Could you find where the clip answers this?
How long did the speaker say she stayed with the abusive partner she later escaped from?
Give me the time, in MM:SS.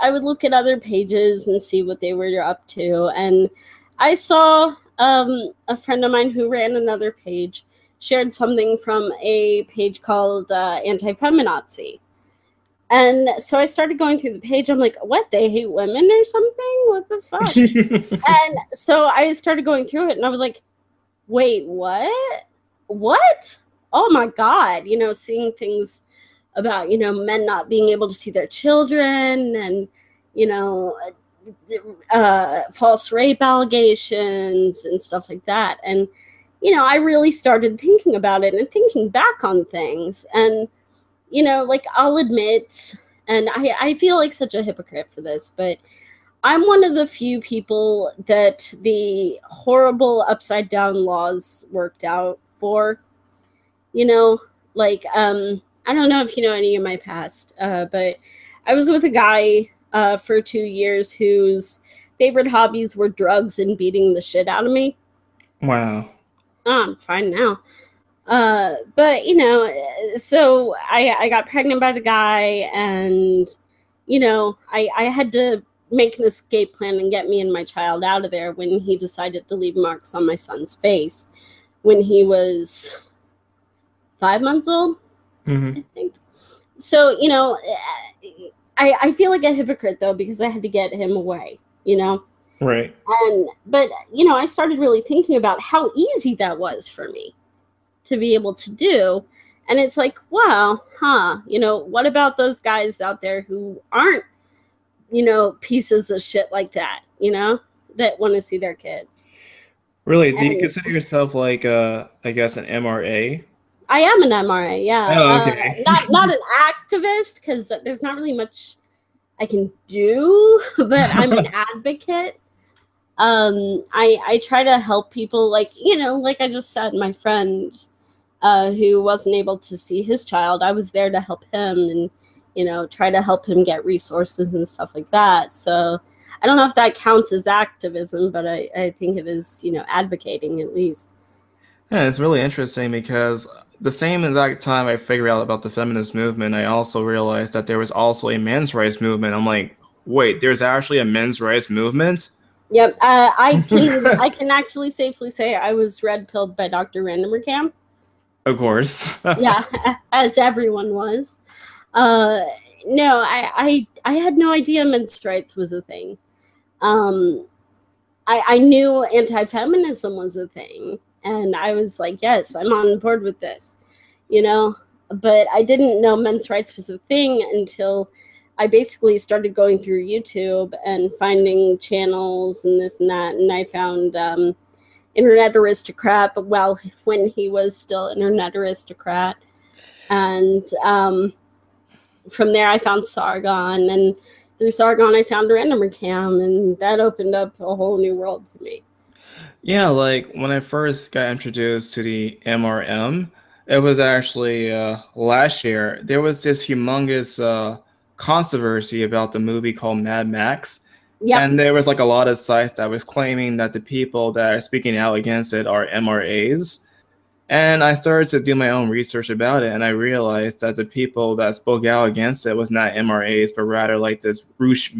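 01:00.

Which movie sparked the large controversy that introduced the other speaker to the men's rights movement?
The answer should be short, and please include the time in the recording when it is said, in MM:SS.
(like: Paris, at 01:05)
Mad Max, at 03:29.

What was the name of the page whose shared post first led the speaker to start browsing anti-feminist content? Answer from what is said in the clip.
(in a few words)
Anti-Feminazi.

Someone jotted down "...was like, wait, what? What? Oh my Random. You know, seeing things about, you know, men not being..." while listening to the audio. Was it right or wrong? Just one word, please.
wrong.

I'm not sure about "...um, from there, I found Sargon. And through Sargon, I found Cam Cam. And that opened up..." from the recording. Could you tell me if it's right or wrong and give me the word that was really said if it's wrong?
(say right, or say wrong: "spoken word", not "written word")
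wrong: "Random", not "Cam".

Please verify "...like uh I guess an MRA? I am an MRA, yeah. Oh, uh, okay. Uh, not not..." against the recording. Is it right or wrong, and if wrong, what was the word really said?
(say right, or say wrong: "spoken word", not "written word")
right.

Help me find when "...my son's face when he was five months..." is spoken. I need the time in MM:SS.
01:20.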